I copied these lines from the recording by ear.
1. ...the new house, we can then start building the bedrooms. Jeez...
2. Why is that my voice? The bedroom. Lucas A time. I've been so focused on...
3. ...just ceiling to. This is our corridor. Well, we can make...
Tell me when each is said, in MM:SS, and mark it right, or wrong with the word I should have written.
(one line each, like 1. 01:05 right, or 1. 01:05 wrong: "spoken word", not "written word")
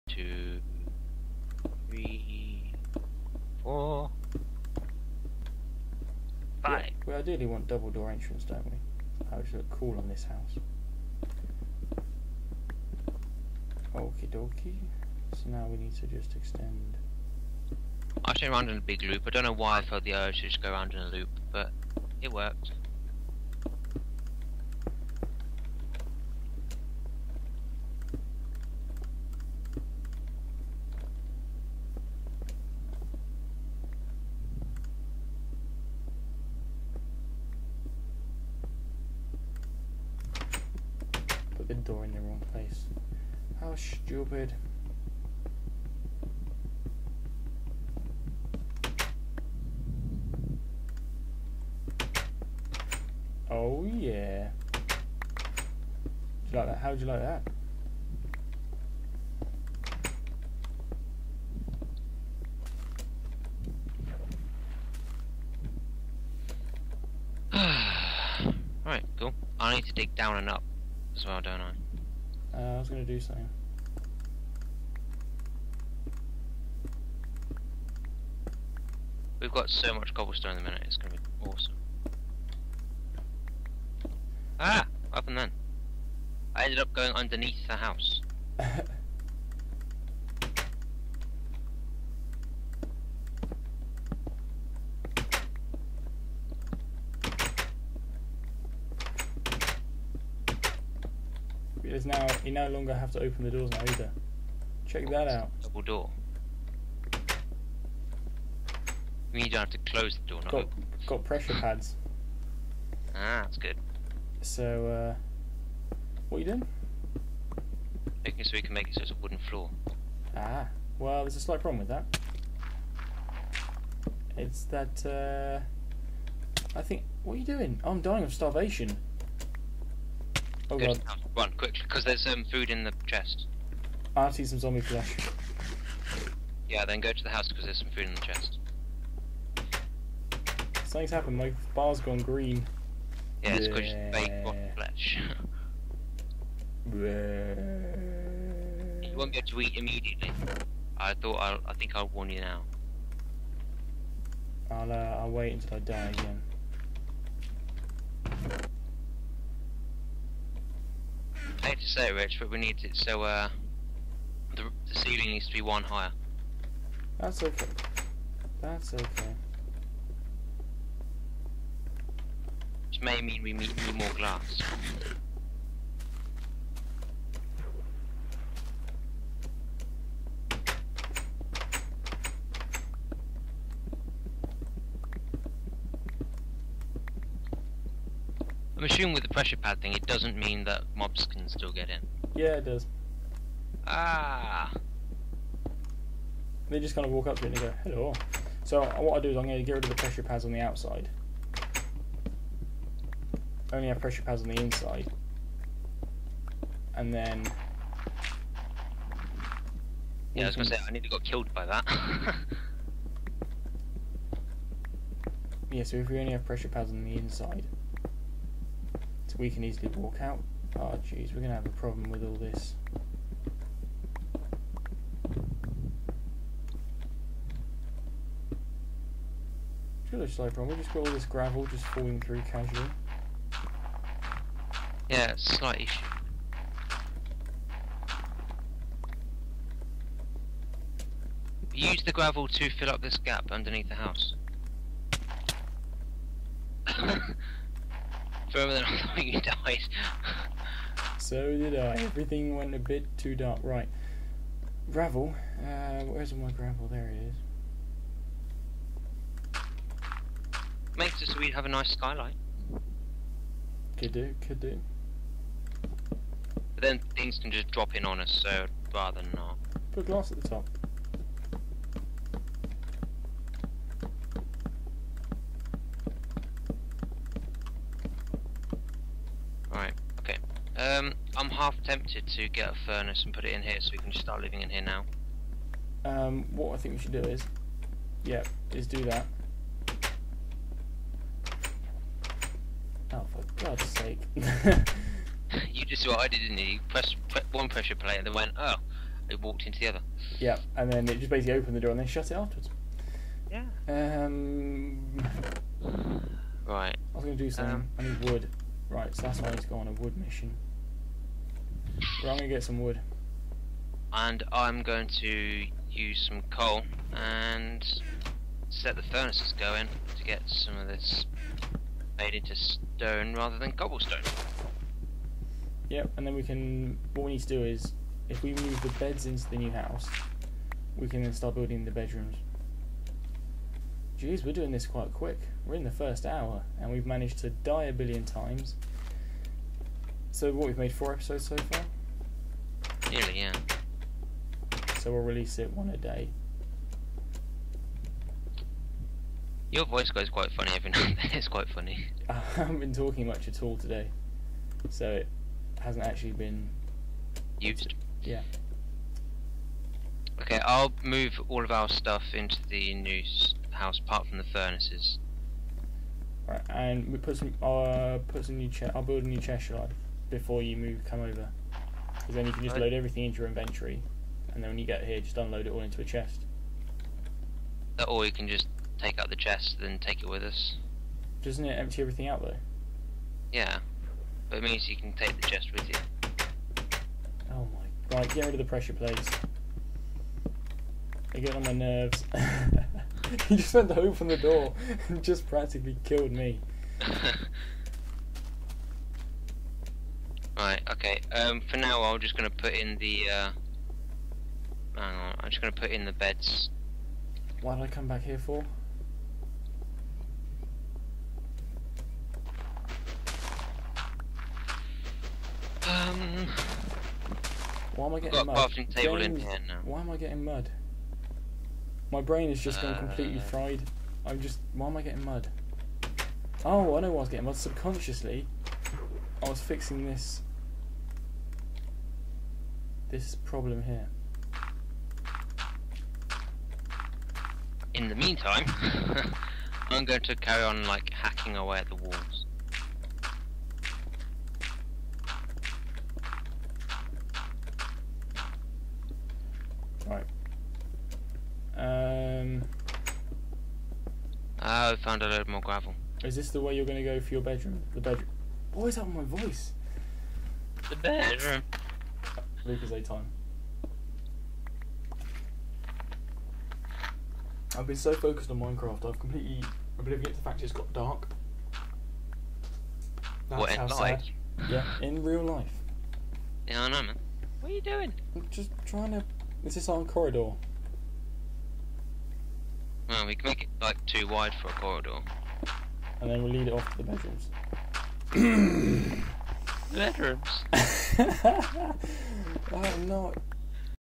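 1. 05:29 right
2. 07:38 right
3. 07:58 wrong: "trying", not "ceiling".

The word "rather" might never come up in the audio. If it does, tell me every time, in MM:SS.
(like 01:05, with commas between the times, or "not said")
04:28, 05:23.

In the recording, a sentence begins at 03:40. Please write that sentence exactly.
Oh jeez, we're gonna have a problem with all this.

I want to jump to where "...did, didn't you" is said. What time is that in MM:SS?
04:56.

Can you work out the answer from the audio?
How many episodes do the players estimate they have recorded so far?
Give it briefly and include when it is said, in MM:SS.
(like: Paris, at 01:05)
4, at 05:40.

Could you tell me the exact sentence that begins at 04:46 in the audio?
Um, what I think we should do is, yeah, is do that.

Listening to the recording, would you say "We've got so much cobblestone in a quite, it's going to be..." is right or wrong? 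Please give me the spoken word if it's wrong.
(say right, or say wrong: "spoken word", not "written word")
wrong: "minute", not "quite".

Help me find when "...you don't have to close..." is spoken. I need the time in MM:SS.
01:49.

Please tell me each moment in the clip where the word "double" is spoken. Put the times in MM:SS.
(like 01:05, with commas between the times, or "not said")
00:07, 01:45.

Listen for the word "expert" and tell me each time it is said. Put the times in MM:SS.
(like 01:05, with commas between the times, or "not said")
not said.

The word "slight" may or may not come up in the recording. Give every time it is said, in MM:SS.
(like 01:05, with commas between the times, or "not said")
02:01, 03:55.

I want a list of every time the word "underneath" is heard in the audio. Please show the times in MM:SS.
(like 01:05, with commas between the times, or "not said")
01:27, 04:03.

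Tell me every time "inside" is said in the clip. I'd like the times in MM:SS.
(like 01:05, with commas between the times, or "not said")
03:24, 03:37.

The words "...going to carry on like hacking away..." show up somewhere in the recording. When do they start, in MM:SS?
07:20.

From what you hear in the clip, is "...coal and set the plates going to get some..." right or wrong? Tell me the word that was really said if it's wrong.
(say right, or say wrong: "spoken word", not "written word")
wrong: "furnaces", not "plates".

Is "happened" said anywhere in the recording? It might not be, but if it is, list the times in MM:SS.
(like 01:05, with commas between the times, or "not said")
01:25, 02:21.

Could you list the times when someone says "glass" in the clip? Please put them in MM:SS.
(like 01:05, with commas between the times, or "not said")
02:54, 04:30.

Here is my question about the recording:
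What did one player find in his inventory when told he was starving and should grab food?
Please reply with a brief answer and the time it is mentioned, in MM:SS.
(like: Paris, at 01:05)
Zombie flesh, at 02:14.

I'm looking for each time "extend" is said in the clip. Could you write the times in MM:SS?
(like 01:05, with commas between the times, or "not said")
00:16.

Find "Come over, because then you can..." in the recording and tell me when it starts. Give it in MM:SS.
06:11.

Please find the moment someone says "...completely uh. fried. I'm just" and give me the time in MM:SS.
07:02.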